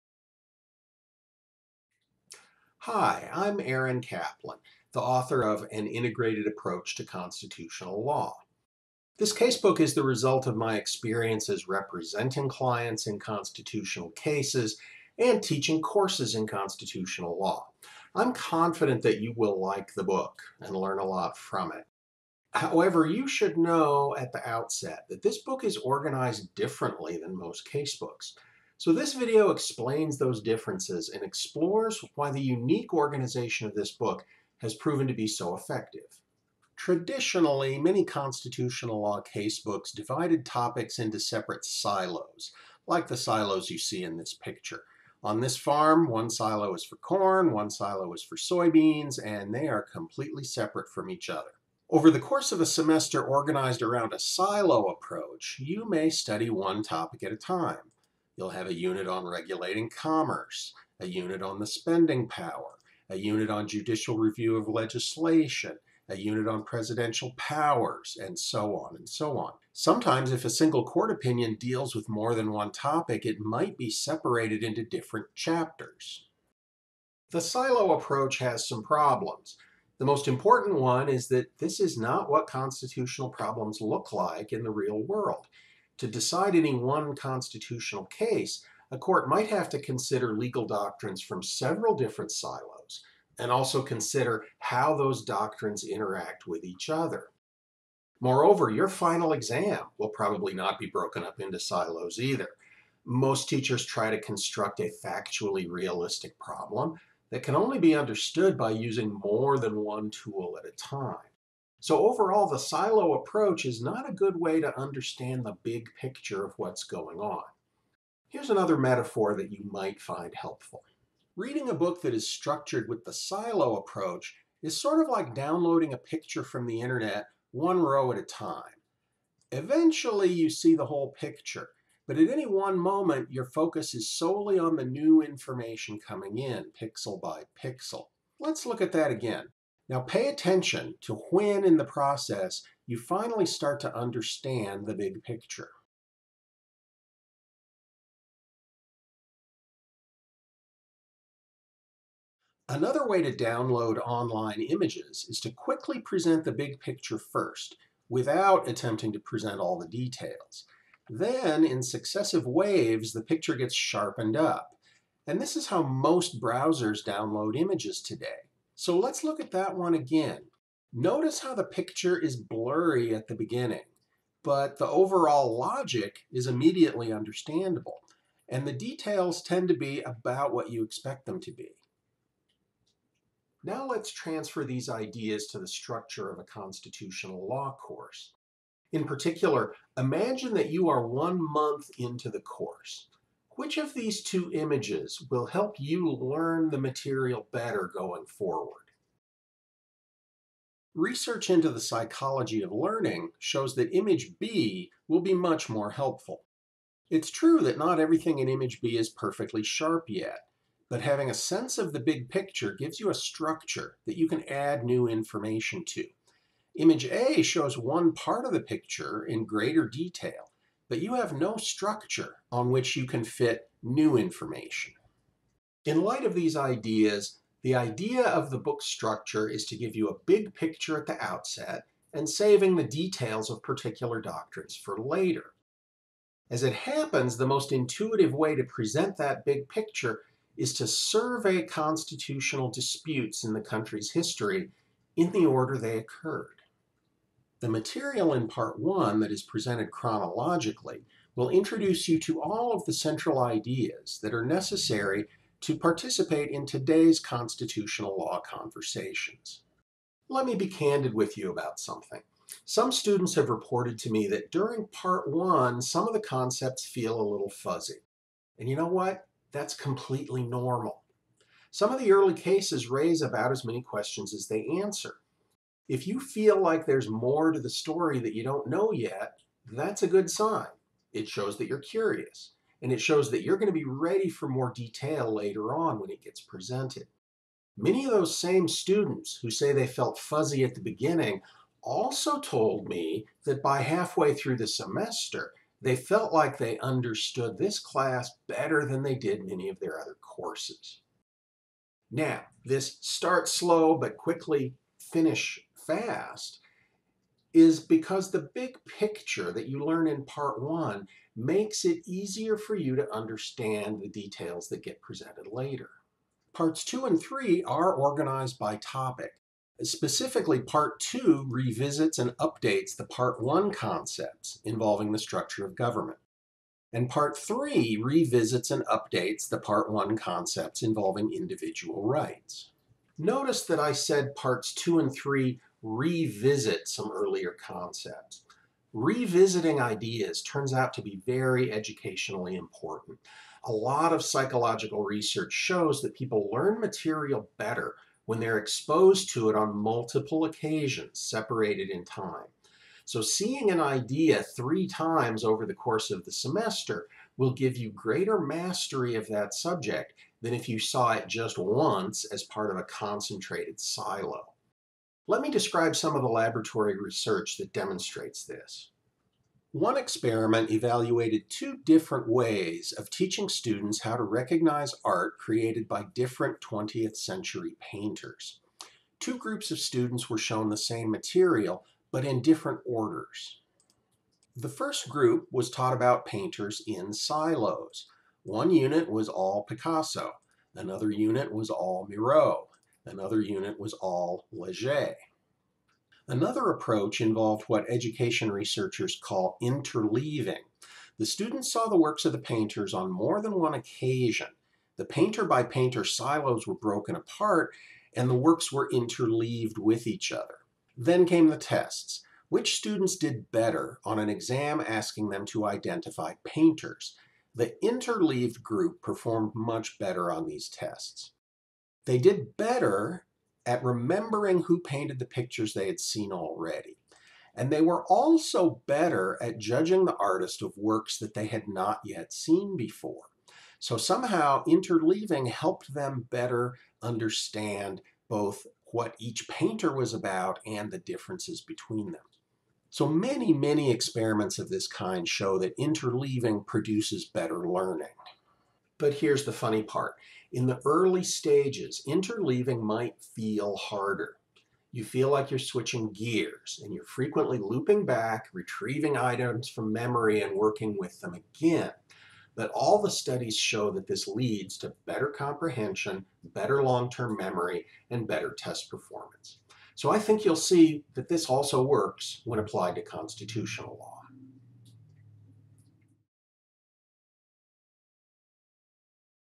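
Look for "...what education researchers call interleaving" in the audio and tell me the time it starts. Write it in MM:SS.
06:37.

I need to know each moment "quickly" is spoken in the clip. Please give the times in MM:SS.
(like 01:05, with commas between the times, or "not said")
02:35, 05:04.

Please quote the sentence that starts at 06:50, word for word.
Then came the tests which students did better on an exam asking them to identify painters.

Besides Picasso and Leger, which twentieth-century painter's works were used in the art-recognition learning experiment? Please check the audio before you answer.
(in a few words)
Miro.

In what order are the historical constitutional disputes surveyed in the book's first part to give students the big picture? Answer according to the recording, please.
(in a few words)
chronologically.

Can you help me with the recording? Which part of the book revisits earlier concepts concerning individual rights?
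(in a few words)
Part 3.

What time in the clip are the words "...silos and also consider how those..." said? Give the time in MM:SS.
01:32.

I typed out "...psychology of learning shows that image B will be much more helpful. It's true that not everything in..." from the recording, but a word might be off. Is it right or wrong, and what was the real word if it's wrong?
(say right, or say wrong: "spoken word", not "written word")
right.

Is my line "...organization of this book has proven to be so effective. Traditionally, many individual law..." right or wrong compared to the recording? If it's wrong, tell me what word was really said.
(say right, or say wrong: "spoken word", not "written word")
wrong: "constitutional", not "individual".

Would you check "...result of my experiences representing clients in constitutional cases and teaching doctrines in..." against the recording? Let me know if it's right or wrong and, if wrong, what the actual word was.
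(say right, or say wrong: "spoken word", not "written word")
wrong: "courses", not "doctrines".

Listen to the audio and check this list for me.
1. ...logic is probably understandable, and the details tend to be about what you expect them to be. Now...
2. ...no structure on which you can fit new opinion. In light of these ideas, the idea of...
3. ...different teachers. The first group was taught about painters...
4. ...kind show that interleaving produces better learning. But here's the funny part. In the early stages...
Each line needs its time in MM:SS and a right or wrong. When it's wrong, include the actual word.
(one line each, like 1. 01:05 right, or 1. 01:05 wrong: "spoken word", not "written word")
1. 02:55 wrong: "immediately", not "probably"
2. 03:41 wrong: "information", not "opinion"
3. 06:22 wrong: "orders", not "teachers"
4. 07:24 right.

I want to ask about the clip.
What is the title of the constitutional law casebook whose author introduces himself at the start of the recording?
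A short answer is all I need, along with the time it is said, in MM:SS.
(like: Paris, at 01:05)
An Integrated Approach to Constitutional Law, at 00:05.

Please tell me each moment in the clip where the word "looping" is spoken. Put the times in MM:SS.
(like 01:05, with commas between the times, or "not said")
07:37.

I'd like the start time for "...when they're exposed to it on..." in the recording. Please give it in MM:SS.
05:48.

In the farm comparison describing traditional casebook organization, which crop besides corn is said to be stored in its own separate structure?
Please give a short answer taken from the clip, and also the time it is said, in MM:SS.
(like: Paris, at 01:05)
soybeans, at 00:48.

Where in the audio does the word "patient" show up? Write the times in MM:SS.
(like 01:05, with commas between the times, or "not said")
not said.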